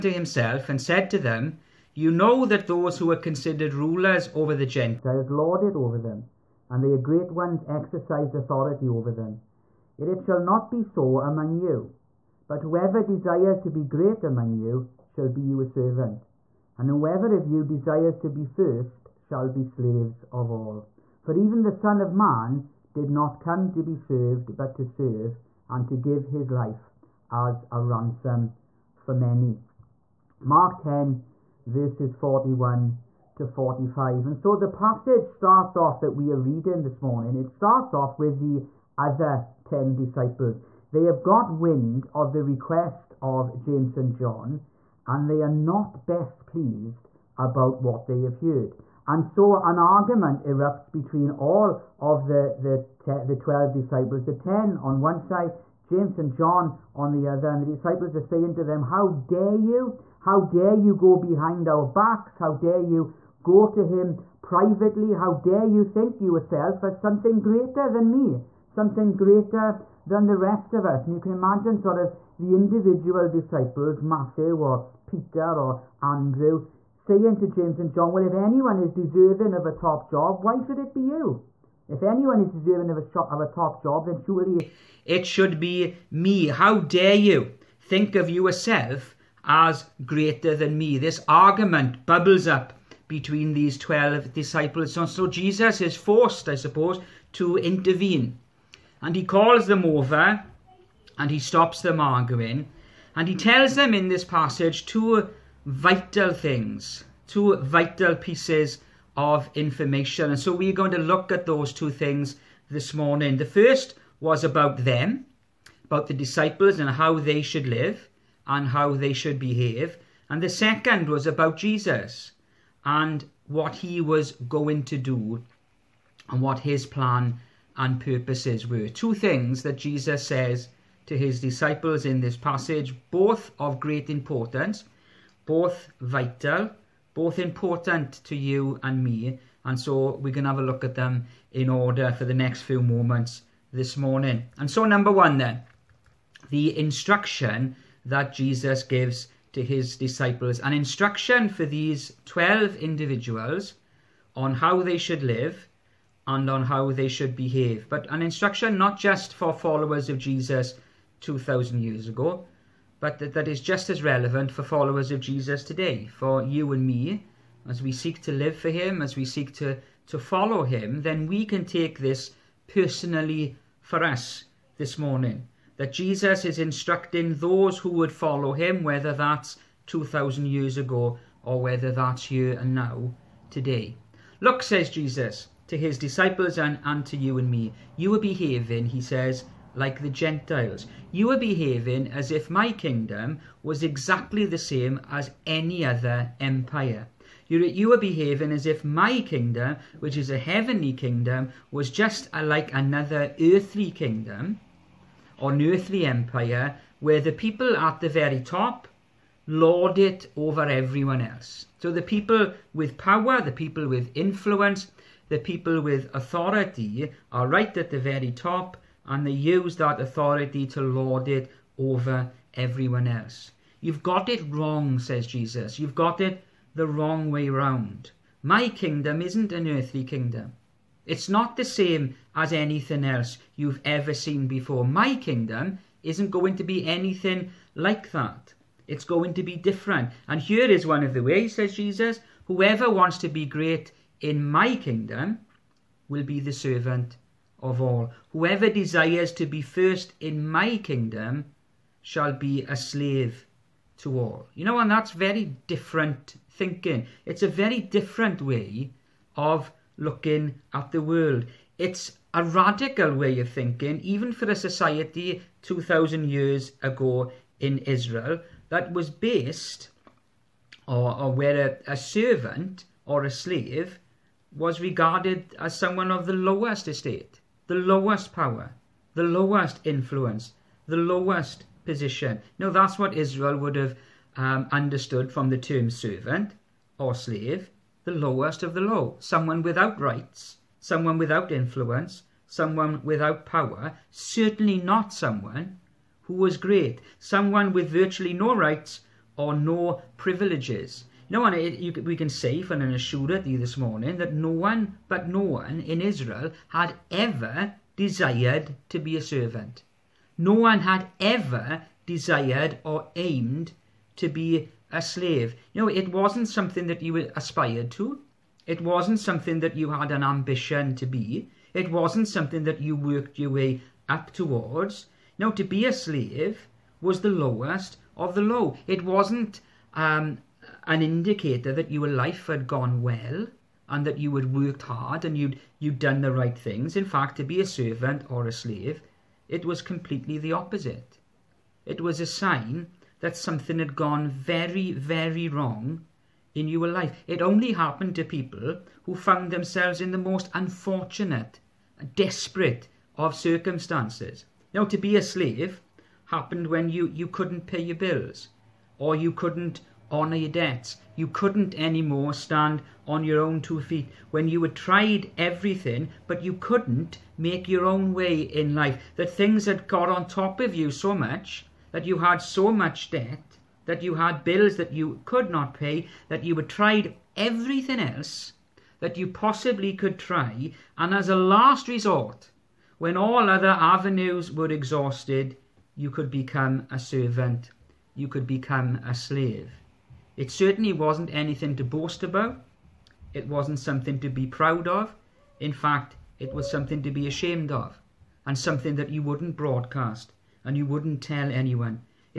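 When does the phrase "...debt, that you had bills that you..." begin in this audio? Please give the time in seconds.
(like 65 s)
373 s.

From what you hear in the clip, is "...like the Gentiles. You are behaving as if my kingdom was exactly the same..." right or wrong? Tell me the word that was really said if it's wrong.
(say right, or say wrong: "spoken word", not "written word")
right.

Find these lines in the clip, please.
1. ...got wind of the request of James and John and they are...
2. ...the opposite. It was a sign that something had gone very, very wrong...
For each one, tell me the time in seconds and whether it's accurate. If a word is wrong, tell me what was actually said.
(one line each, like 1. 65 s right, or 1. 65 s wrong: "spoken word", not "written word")
1. 41 s right
2. 340 s right.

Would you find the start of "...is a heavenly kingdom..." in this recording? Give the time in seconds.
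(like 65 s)
200 s.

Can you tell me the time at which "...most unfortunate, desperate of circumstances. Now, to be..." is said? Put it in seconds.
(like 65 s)
350 s.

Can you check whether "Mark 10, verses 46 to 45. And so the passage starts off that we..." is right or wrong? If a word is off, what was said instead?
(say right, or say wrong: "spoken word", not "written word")
wrong: "41", not "46".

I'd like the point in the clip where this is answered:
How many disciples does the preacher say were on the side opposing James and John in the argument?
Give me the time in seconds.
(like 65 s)
54 s.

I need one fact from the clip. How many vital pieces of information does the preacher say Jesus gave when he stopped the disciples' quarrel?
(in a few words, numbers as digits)
2.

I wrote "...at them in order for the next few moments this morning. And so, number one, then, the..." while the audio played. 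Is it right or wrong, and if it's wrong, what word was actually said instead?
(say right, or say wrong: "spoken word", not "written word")
right.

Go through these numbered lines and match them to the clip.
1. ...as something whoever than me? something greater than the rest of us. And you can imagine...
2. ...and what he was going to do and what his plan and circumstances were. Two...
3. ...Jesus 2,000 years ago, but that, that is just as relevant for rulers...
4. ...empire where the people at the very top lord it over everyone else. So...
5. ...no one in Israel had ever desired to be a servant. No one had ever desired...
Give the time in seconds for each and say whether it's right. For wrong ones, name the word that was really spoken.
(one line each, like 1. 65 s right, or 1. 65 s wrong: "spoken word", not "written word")
1. 66 s wrong: "greater", not "whoever"
2. 122 s wrong: "purposes", not "circumstances"
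3. 160 s wrong: "followers", not "rulers"
4. 206 s right
5. 305 s right.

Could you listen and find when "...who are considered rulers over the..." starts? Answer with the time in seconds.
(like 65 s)
2 s.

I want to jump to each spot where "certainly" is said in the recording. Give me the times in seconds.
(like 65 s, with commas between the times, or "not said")
294 s, 390 s.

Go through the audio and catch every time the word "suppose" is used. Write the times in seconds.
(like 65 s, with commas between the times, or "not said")
96 s.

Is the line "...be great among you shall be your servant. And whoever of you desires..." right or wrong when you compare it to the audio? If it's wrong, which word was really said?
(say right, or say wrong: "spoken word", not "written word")
right.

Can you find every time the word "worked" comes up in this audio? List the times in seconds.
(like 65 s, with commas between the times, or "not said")
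322 s, 334 s.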